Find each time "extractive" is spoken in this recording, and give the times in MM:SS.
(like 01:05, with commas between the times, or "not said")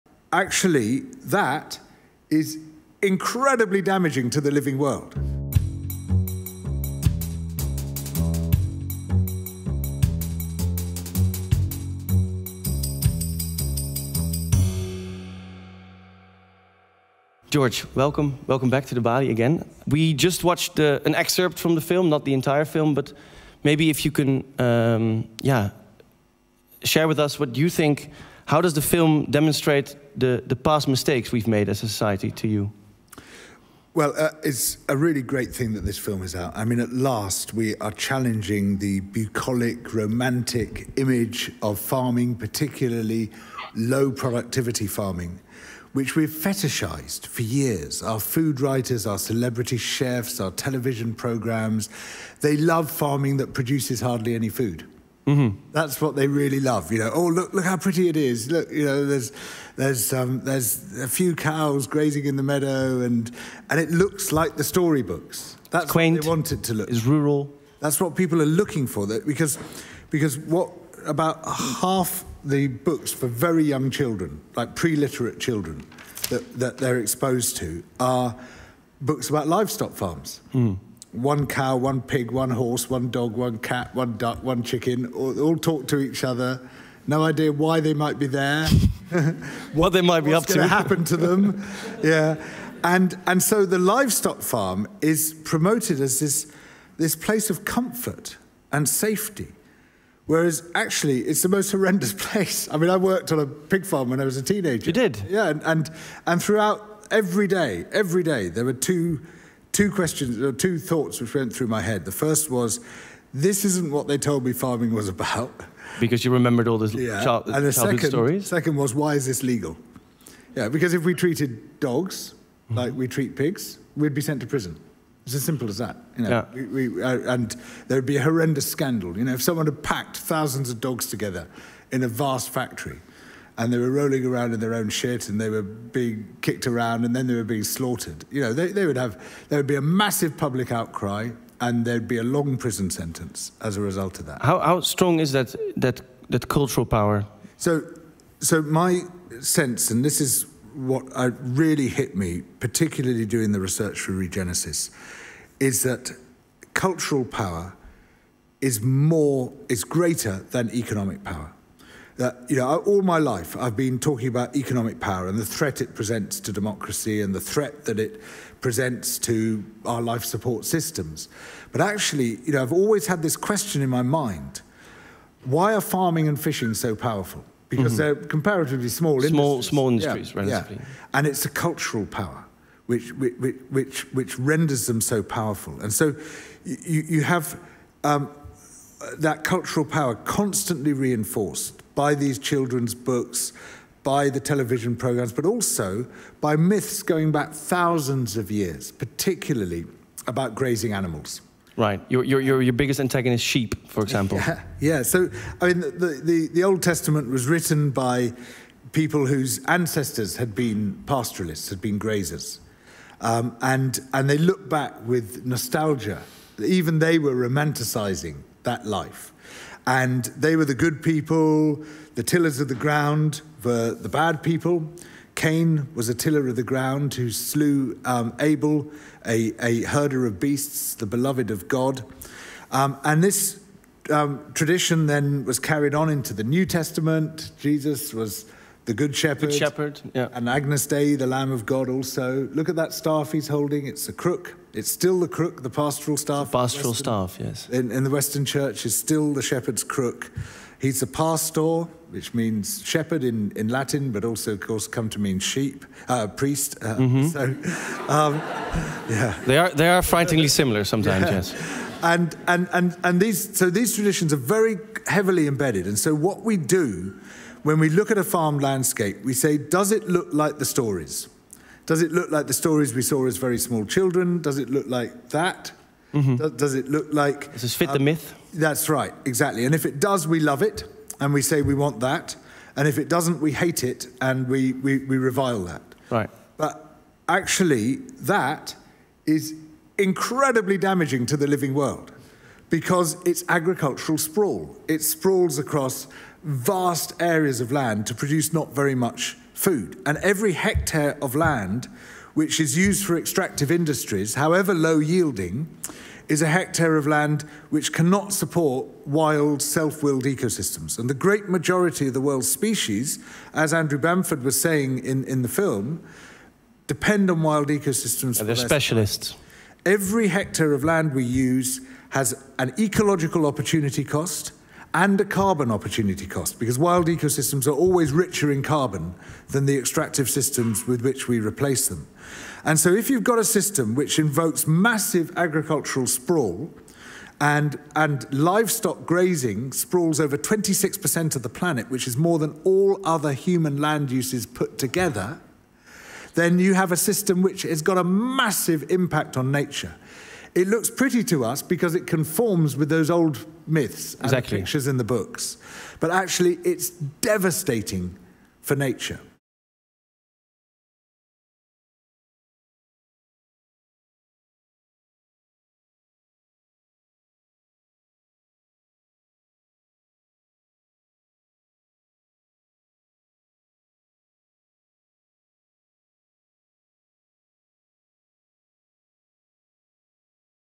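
05:03, 05:29.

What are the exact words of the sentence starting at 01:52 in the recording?
The first was, this isn't what they told me farming was about.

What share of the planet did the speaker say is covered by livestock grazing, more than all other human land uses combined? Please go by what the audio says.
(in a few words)
26%.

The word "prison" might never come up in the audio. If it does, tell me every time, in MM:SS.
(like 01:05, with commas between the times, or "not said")
02:04, 02:22.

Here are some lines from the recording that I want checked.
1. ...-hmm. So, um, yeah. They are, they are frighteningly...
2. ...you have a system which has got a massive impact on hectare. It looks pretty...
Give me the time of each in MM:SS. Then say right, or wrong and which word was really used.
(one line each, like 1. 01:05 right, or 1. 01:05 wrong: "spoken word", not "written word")
1. 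04:17 right
2. 05:46 wrong: "nature", not "hectare".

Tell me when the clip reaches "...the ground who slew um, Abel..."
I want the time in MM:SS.
03:46.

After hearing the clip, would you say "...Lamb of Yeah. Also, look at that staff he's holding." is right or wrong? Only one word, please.
wrong.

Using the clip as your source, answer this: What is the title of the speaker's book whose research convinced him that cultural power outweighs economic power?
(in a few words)
Regenesis.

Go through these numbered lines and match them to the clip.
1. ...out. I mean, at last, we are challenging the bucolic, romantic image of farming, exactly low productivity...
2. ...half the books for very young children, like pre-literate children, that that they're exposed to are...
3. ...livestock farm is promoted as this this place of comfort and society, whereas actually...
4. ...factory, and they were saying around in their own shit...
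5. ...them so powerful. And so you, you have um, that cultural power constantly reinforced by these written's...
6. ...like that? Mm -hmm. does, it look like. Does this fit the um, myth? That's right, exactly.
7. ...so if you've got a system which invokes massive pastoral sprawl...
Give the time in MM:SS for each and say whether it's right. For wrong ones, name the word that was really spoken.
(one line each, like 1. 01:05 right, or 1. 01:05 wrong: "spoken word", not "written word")
1. 00:36 wrong: "particularly", not "exactly"
2. 01:11 right
3. 01:33 wrong: "safety", not "society"
4. 02:12 wrong: "rolling", not "saying"
5. 03:04 wrong: "children", not "written"
6. 04:34 right
7. 05:32 wrong: "agricultural", not "pastoral".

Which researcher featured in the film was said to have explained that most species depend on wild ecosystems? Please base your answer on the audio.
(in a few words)
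Andrew Balmford.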